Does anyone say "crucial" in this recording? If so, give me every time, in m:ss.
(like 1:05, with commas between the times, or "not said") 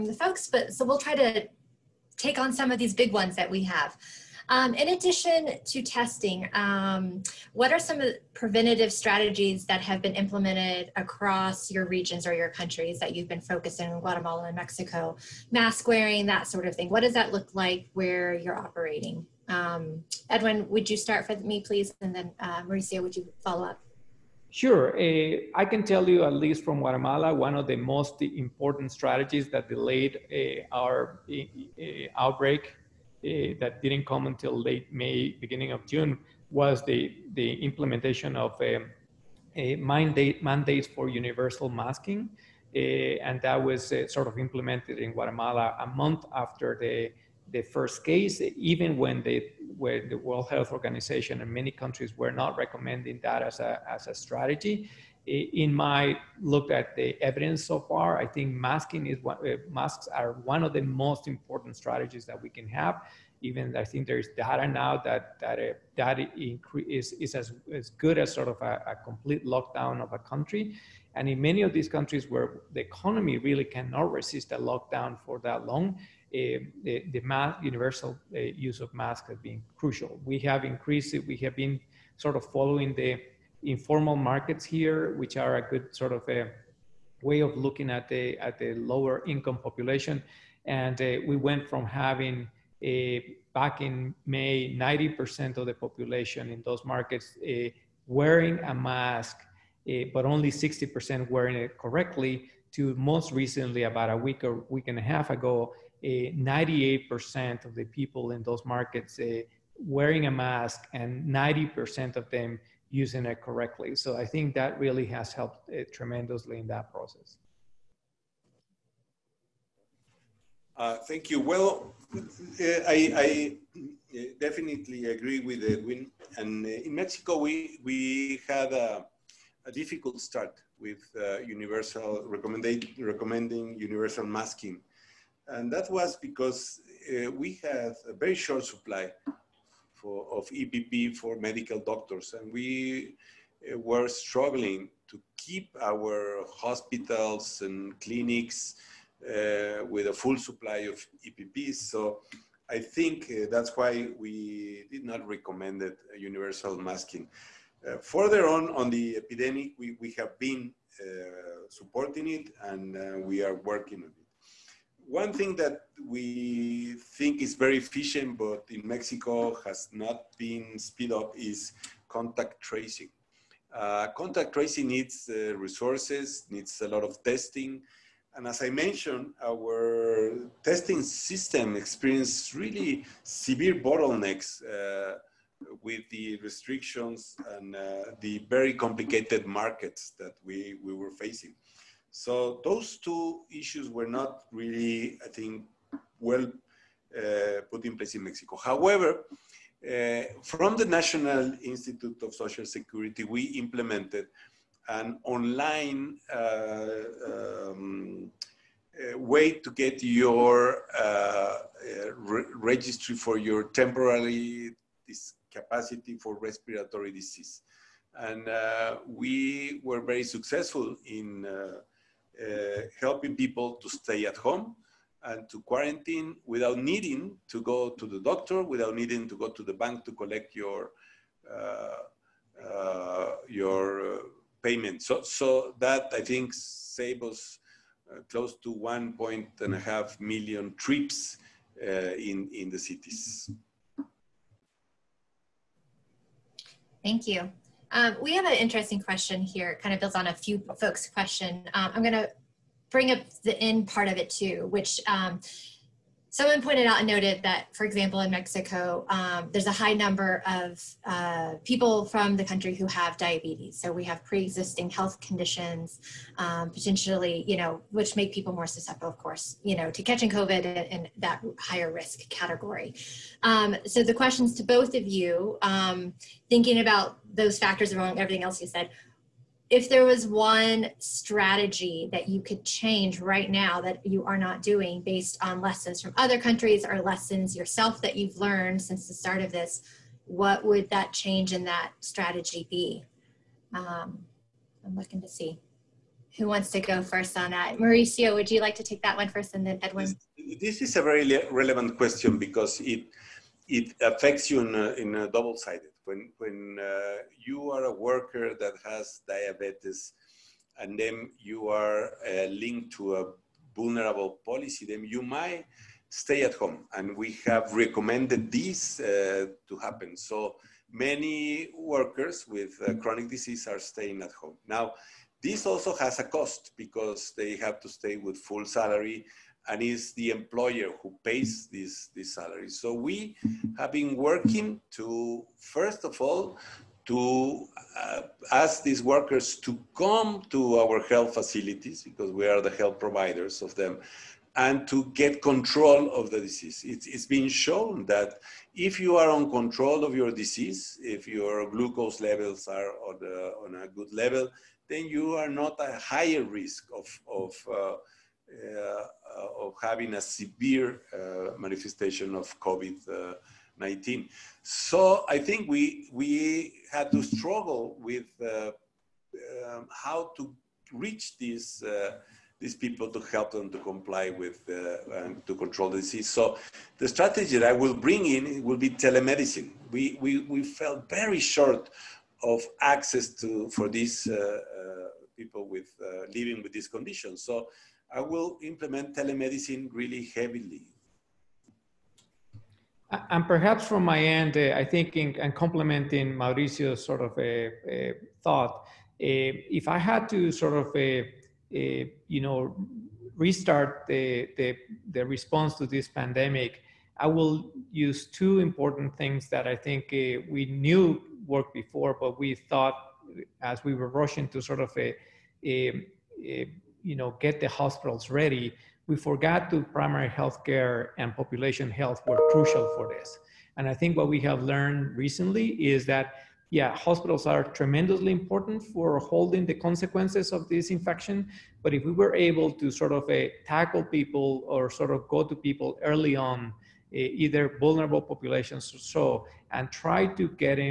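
1:19, 7:02.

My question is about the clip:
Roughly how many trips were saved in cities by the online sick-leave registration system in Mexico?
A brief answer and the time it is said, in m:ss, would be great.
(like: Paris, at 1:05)
1.5 million, at 3:58.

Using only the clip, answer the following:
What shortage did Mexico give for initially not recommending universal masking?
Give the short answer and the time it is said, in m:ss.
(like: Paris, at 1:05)
EPP, at 2:20.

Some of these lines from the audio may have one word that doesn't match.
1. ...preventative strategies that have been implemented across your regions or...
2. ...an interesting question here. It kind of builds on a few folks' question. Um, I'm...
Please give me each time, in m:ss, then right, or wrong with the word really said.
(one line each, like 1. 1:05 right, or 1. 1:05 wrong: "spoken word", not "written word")
1. 0:08 right
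2. 4:08 right.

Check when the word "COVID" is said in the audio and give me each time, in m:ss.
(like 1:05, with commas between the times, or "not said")
4:30, 6:02.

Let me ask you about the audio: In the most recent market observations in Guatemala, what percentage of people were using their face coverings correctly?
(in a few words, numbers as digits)
90%.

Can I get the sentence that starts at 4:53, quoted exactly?
Um, I'm looking to see who wants to go first on that.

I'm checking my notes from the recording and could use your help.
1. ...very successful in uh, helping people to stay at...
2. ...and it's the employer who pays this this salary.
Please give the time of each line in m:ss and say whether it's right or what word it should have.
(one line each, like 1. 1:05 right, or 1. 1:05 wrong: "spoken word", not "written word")
1. 3:40 right
2. 5:29 right.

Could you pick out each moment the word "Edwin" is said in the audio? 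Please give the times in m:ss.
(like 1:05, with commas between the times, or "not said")
0:20, 2:05, 4:59.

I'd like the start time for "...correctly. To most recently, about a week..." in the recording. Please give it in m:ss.
1:41.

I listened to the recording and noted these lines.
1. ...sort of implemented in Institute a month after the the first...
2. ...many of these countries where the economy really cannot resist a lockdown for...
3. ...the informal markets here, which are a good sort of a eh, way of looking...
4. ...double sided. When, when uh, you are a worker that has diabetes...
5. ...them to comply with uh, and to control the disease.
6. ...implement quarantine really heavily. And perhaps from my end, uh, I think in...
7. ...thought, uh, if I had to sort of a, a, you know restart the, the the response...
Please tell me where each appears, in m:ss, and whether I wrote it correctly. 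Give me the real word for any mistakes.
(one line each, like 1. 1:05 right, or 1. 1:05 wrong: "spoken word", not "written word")
1. 0:44 wrong: "Guatemala", not "Institute"
2. 1:11 right
3. 1:22 right
4. 5:05 right
5. 6:13 right
6. 6:28 wrong: "telemedicine", not "quarantine"
7. 6:38 right.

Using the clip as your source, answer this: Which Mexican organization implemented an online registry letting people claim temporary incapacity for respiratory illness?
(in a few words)
National Institute of Social Security.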